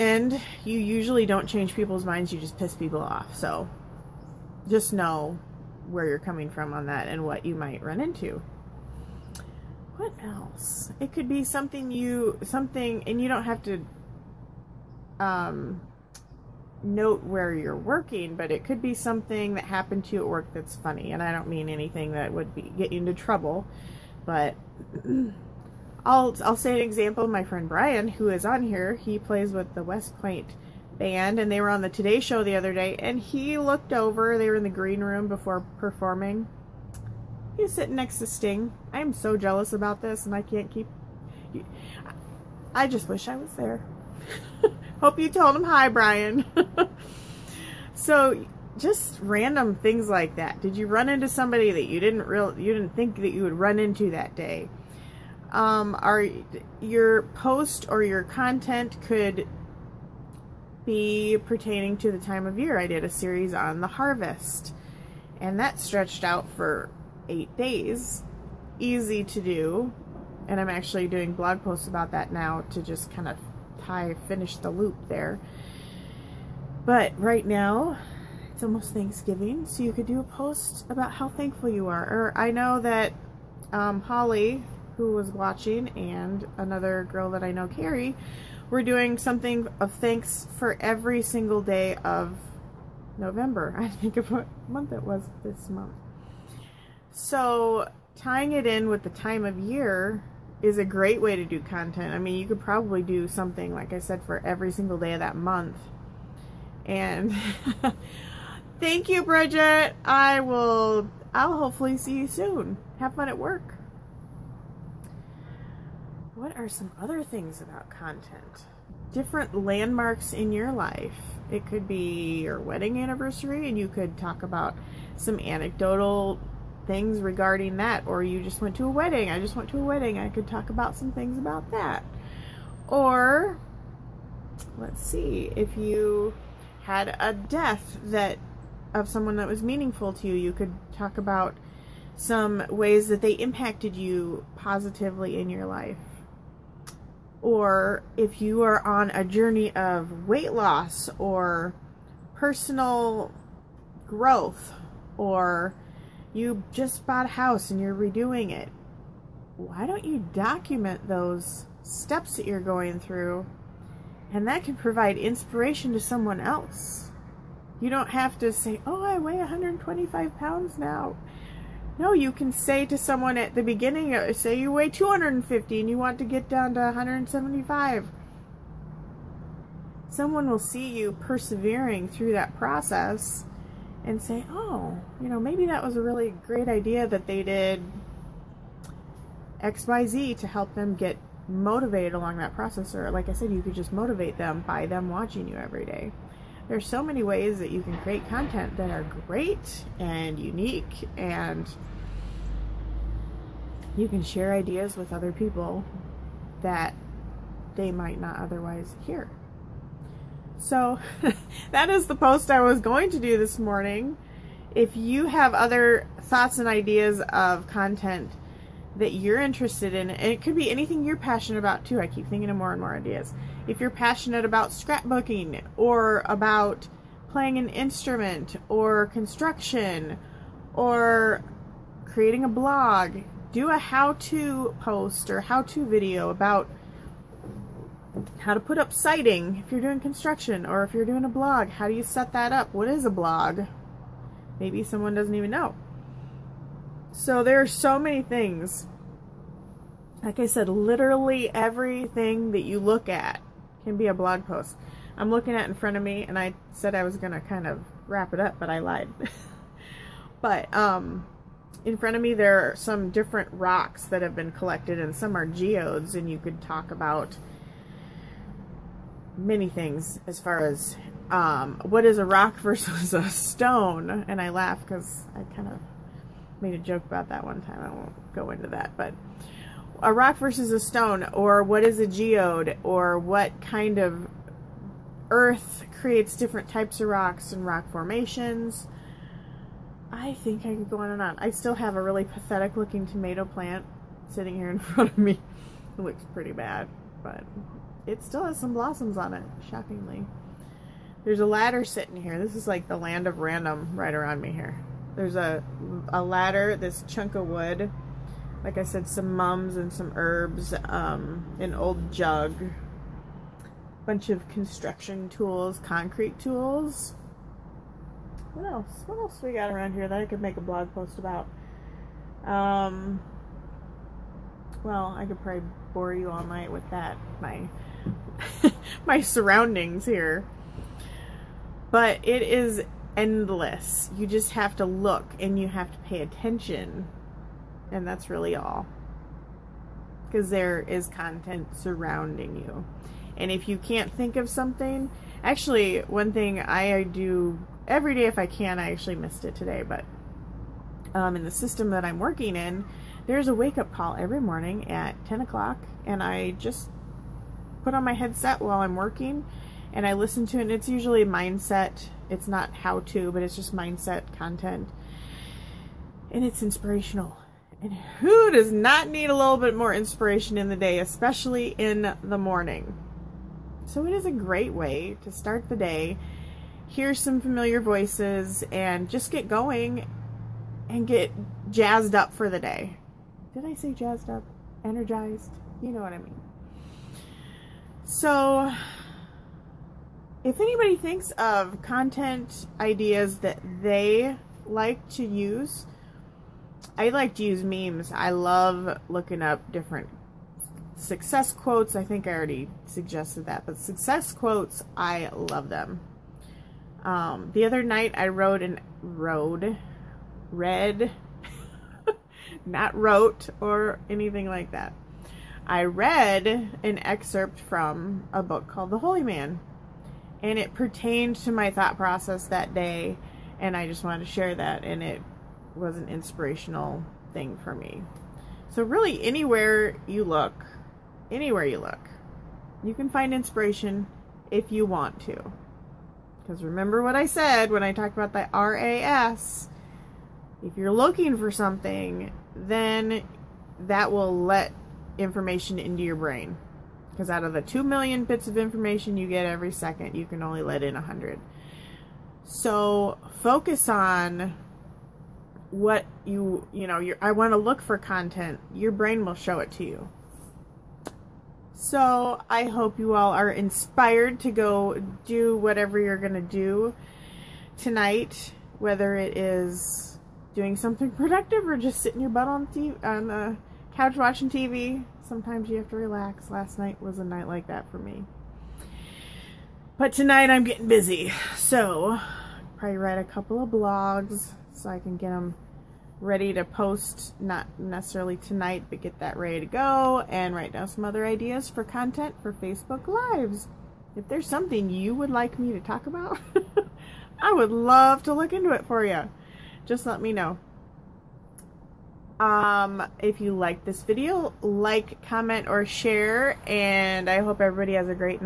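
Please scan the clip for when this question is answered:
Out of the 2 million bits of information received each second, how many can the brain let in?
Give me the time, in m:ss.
7:30.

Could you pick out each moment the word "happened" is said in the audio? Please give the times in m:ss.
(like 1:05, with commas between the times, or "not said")
0:19.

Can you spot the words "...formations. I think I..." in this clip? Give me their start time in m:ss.
4:47.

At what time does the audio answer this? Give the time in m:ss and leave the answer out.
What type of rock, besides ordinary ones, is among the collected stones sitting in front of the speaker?
4:25.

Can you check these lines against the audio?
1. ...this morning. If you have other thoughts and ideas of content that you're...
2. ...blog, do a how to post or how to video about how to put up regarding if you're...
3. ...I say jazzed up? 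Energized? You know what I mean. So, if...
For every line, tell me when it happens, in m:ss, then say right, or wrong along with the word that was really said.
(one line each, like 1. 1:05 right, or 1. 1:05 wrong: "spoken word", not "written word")
1. 3:33 right
2. 3:52 wrong: "siding", not "regarding"
3. 6:23 right.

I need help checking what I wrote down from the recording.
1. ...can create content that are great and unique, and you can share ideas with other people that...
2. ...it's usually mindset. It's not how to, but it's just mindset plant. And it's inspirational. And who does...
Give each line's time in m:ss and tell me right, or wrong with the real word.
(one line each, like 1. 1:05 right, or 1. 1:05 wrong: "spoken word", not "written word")
1. 3:17 right
2. 6:00 wrong: "content", not "plant".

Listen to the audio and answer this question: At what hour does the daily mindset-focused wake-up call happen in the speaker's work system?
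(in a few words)
10 o'clock.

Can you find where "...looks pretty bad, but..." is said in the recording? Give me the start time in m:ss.
4:56.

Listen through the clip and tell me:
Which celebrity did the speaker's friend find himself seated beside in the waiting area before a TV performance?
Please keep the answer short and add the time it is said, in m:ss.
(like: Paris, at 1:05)
Sting, at 0:38.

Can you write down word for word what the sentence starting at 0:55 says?
Um, are your post or your content could be pertaining to the time of year?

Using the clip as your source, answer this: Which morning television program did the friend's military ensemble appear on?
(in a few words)
Today Show.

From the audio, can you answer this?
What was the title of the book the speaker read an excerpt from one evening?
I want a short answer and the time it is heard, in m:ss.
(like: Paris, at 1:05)
The Holy Man, at 6:58.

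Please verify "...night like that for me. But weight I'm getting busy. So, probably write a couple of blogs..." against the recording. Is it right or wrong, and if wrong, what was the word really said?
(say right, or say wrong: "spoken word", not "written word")
wrong: "tonight", not "weight".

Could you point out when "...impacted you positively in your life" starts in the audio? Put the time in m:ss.
2:23.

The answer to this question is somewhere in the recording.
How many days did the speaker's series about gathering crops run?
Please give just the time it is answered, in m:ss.
1:07.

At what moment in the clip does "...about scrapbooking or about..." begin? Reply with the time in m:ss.
3:44.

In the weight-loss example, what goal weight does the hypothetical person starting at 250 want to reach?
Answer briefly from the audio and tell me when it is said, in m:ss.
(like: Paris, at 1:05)
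175, at 2:56.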